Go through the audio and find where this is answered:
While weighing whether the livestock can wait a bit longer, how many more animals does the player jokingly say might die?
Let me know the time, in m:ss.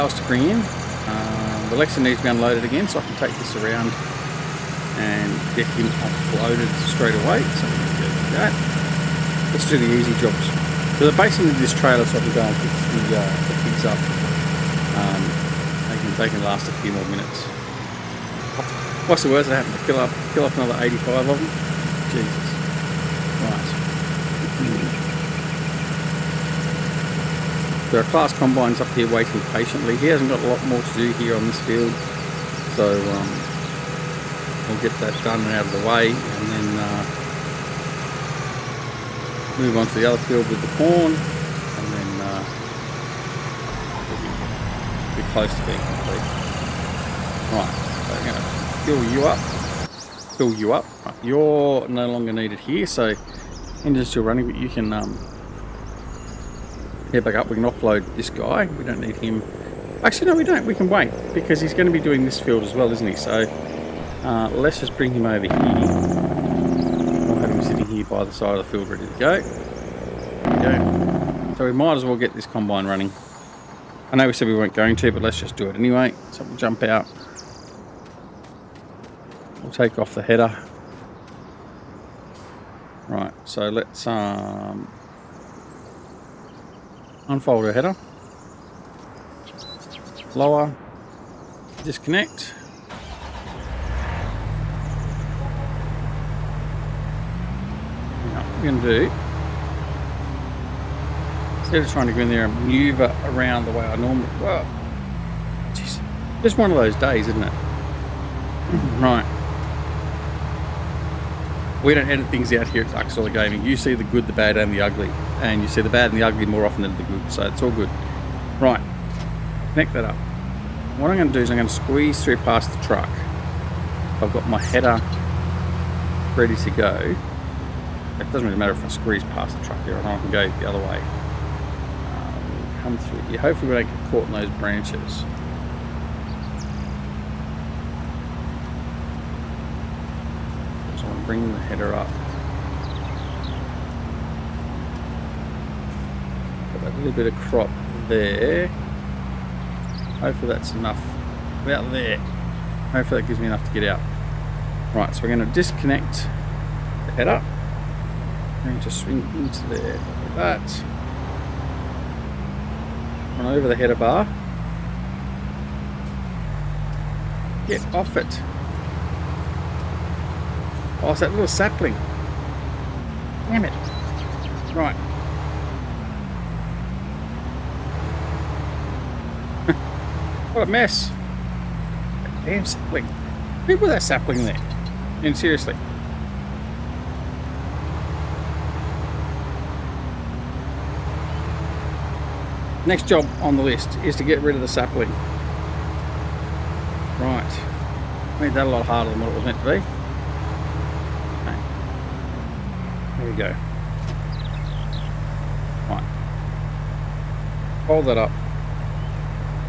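0:20.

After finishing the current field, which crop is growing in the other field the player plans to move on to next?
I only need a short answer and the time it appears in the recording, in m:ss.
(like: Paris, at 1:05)
corn, at 0:40.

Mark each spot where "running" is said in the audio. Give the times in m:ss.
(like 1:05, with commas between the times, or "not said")
0:54, 1:12.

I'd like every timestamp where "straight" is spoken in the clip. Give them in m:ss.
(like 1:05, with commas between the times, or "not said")
0:06.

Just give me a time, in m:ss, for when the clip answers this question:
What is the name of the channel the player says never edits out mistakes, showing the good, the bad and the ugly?
1:53.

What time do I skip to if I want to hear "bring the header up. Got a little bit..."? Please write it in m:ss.
2:21.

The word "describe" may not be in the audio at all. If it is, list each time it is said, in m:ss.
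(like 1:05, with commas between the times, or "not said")
not said.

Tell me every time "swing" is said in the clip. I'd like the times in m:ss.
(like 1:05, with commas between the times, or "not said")
2:39.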